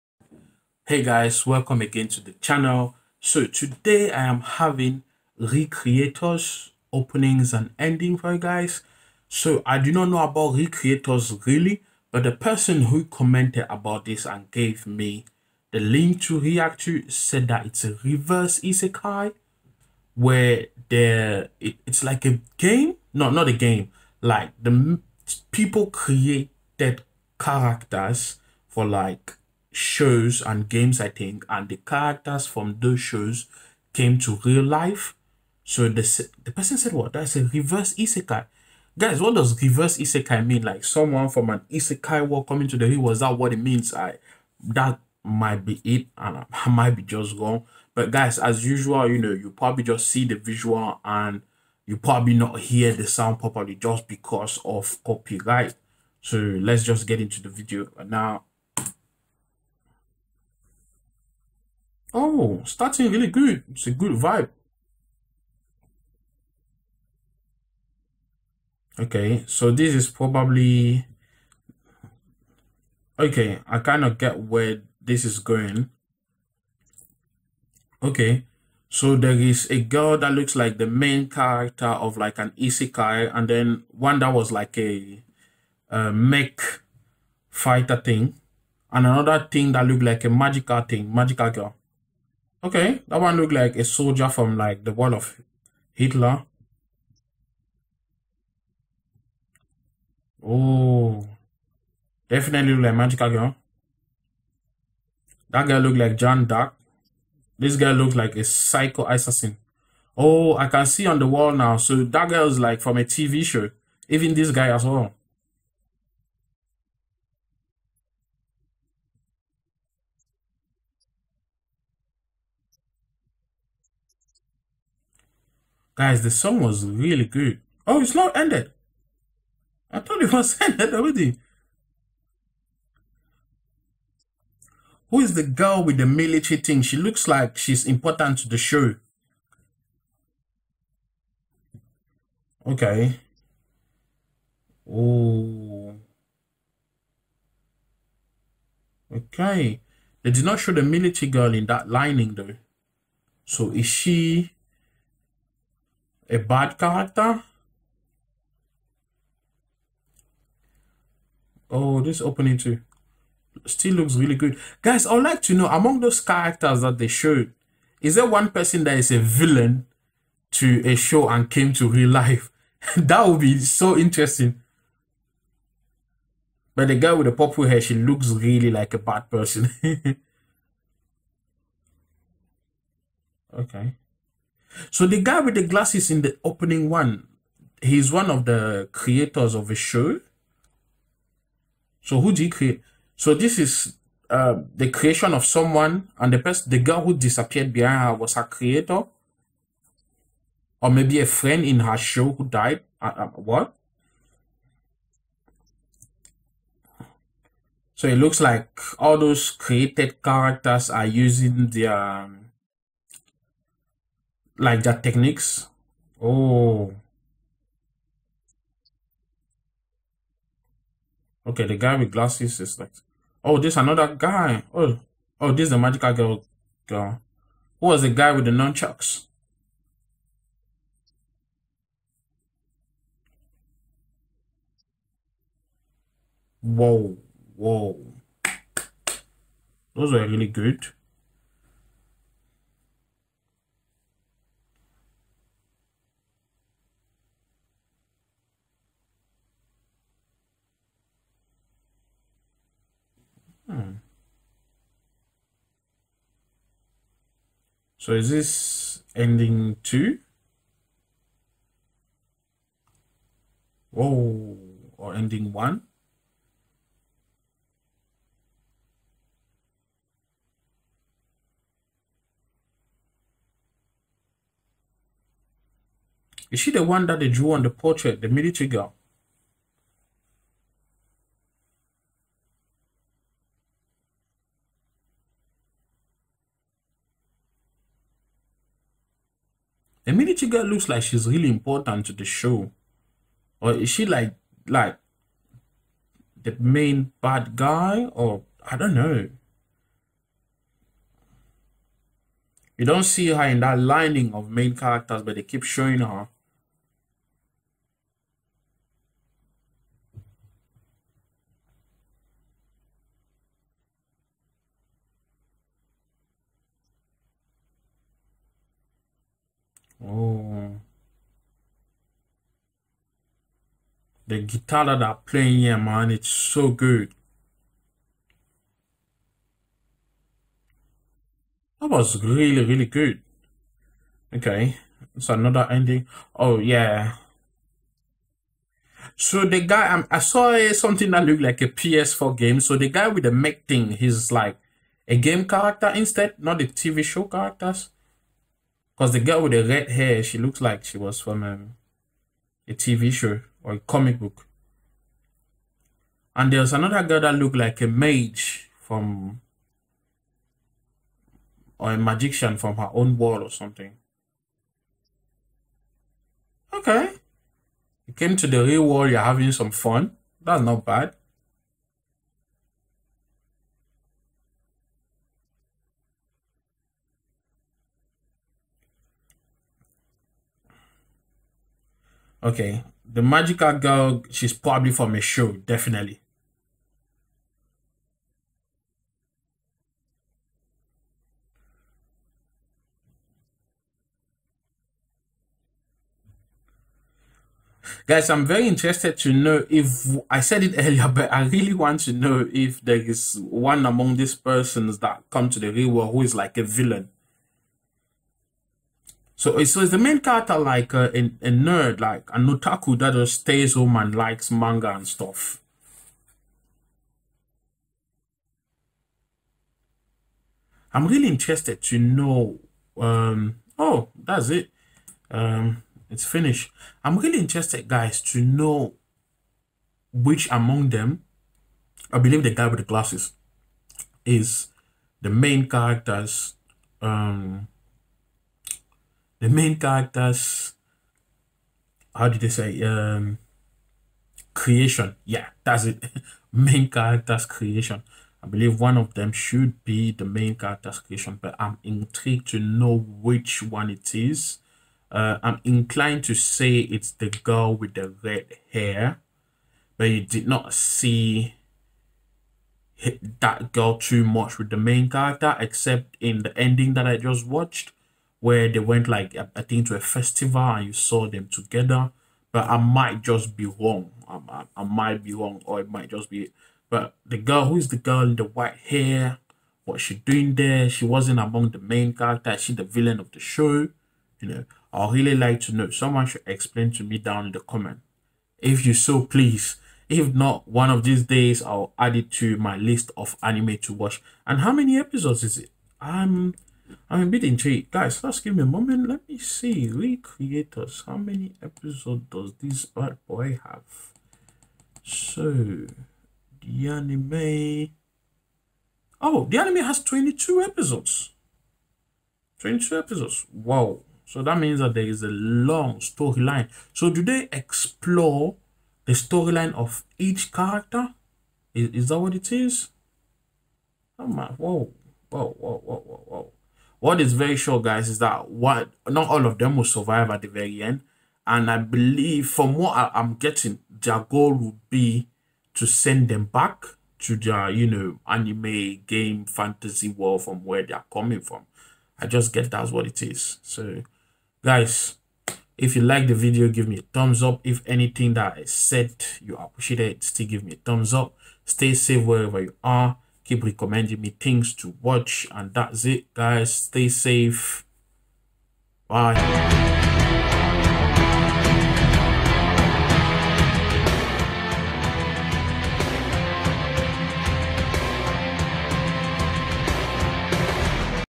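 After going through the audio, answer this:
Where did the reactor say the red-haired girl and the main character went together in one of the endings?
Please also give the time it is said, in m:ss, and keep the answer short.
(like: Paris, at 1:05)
a festival, at 7:49.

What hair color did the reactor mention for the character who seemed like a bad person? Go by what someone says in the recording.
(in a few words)
purple.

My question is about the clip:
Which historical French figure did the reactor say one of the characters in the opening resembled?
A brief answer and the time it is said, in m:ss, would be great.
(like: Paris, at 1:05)
Jeanne d'Arc, at 1:46.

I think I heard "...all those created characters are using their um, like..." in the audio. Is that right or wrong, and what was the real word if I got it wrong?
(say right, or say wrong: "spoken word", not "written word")
right.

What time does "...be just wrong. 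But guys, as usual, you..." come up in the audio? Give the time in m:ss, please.
0:46.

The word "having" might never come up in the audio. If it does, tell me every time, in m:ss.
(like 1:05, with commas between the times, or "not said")
0:04, 6:09.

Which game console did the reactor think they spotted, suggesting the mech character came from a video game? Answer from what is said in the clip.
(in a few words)
PS4.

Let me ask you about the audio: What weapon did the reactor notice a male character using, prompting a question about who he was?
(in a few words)
nunchucks.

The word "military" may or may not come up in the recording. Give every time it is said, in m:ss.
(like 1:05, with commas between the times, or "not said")
2:16, 2:30, 4:38, 4:50.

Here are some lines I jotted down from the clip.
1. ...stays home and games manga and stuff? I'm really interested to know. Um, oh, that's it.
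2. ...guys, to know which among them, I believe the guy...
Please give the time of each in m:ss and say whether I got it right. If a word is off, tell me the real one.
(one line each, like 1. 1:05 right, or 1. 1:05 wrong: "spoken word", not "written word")
1. 6:53 wrong: "likes", not "games"
2. 7:07 right.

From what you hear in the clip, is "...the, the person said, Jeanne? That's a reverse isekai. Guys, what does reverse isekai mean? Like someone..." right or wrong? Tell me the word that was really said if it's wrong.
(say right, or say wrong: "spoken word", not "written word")
wrong: "What", not "Jeanne".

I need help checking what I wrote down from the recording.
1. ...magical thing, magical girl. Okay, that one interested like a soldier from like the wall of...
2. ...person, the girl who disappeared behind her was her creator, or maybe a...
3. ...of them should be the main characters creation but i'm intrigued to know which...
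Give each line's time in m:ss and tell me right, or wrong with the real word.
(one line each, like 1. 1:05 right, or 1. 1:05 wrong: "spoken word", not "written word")
1. 1:30 wrong: "looked", not "interested"
2. 3:16 right
3. 7:28 right.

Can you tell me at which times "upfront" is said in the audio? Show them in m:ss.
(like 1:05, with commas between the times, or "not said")
not said.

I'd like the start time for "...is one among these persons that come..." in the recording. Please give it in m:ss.
6:42.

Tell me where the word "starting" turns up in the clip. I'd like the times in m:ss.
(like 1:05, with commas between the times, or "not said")
1:02.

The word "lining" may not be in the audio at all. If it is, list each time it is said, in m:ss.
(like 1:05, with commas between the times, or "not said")
2:31, 5:03.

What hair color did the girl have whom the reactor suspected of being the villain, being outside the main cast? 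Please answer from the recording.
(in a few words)
white.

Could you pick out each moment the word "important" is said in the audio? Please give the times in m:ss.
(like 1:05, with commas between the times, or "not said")
2:17, 4:51.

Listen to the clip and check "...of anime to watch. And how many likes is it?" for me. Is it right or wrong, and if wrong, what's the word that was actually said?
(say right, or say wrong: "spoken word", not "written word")
wrong: "episodes", not "likes".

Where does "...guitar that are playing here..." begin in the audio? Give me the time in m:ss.
5:24.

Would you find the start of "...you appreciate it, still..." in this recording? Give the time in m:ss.
9:09.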